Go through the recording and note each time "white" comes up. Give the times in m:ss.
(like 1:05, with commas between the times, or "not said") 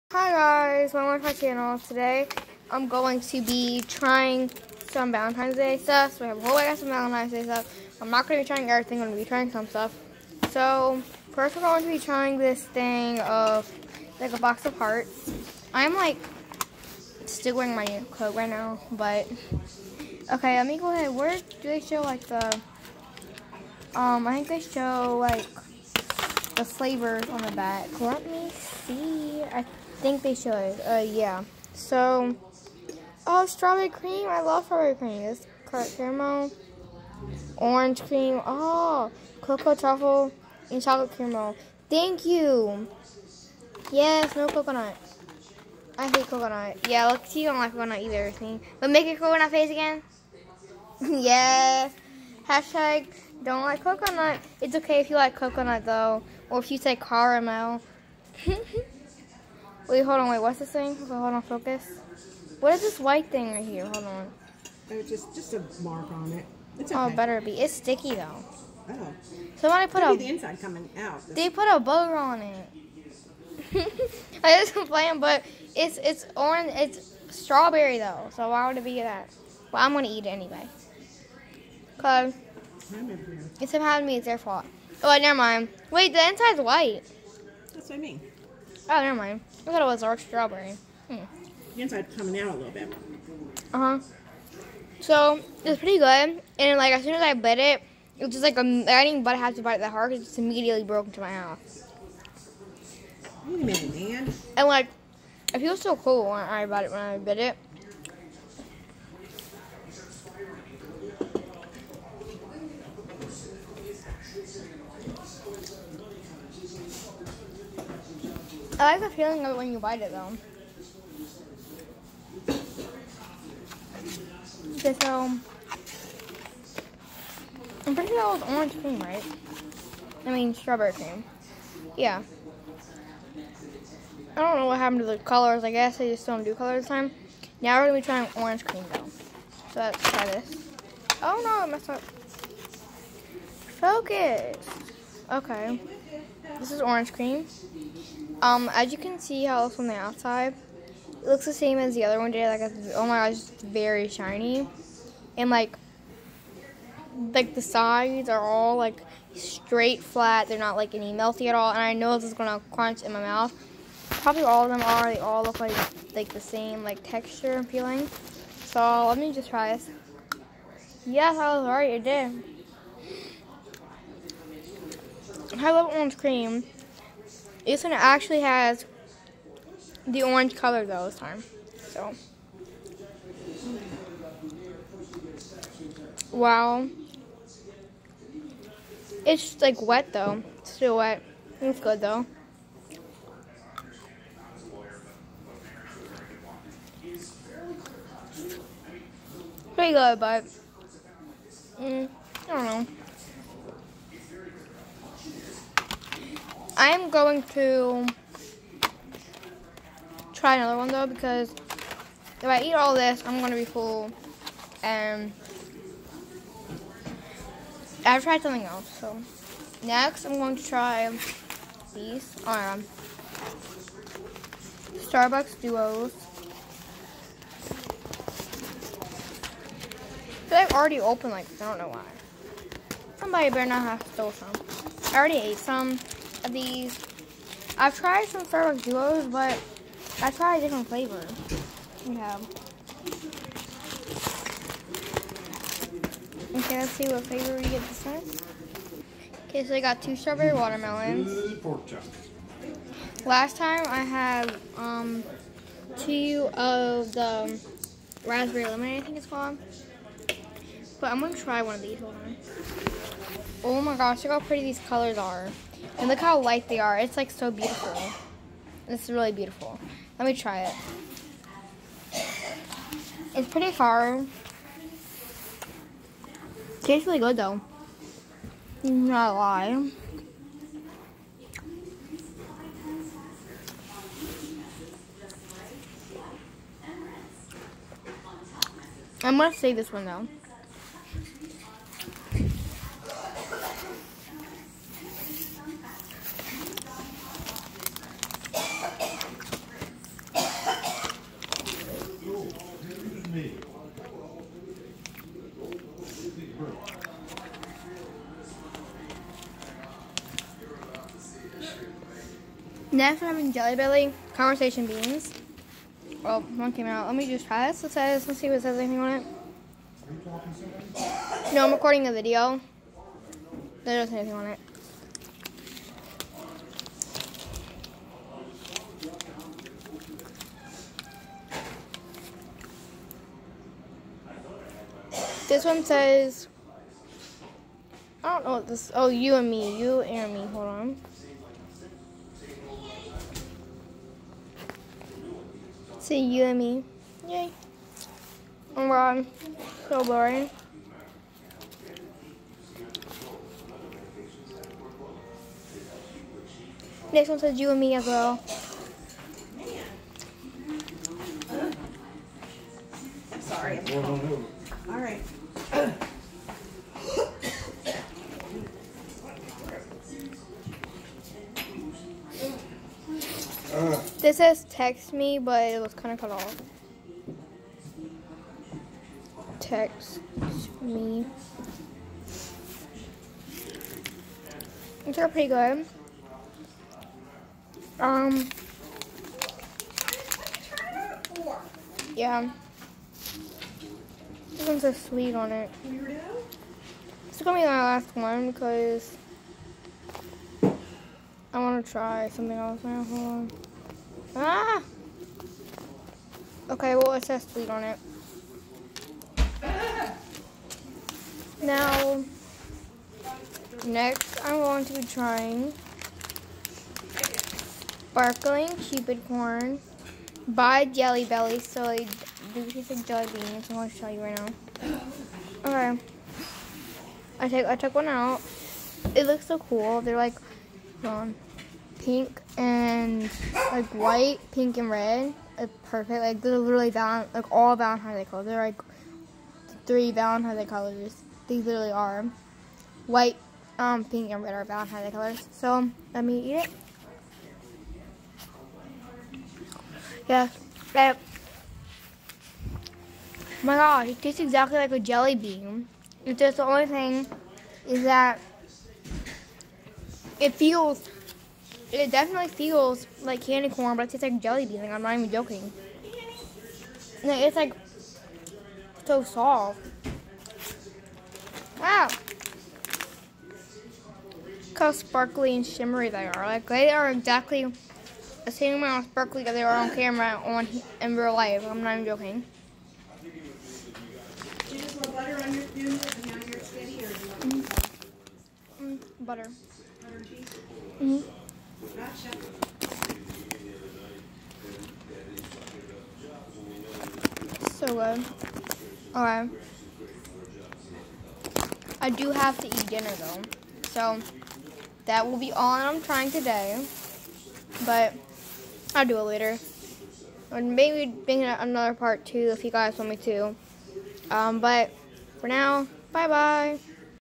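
1:02, 1:26, 7:13, 7:23.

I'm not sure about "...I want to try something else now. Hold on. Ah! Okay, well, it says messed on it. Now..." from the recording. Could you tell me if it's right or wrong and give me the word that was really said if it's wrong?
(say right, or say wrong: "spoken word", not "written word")
wrong: "bleed", not "messed".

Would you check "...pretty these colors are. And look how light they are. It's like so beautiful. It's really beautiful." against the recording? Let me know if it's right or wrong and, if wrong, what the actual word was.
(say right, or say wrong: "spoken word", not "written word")
right.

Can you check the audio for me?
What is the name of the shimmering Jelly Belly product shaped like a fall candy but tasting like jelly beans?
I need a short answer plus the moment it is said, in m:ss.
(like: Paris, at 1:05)
Sparkling Cupid Corn, at 6:58.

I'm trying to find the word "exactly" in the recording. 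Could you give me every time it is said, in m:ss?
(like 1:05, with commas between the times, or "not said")
7:34, 7:57.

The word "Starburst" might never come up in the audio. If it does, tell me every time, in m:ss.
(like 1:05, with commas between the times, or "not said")
3:45, 3:58.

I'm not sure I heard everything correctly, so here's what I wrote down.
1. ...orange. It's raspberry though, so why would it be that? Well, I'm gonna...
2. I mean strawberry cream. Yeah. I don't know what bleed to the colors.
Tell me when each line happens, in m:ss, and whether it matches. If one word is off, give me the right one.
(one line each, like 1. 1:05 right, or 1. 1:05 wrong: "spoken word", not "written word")
1. 1:16 wrong: "strawberry", not "raspberry"
2. 2:10 wrong: "happened", not "bleed".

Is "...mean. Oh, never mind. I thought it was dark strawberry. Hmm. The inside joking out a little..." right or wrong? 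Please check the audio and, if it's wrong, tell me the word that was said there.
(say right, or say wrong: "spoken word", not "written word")
wrong: "coming", not "joking".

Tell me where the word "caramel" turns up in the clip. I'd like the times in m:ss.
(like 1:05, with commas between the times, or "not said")
0:35, 0:41, 0:56.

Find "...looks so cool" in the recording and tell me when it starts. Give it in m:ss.
7:09.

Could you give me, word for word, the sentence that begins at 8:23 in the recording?
So, that will be all I'm trying today.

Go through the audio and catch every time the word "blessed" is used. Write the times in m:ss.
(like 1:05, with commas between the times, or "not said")
not said.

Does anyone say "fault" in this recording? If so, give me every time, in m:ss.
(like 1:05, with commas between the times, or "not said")
1:24.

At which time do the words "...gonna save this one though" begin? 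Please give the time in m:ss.
4:49.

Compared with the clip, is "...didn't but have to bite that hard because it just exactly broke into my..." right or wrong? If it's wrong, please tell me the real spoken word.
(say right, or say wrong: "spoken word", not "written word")
wrong: "immediately", not "exactly".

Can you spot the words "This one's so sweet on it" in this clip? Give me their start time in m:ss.
6:34.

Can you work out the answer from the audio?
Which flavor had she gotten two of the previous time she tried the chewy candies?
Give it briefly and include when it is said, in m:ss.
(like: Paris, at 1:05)
Raspberry lemonade, at 4:18.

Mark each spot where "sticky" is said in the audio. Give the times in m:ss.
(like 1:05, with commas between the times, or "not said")
1:07.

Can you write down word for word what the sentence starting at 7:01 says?
So I do taste like jelly beans.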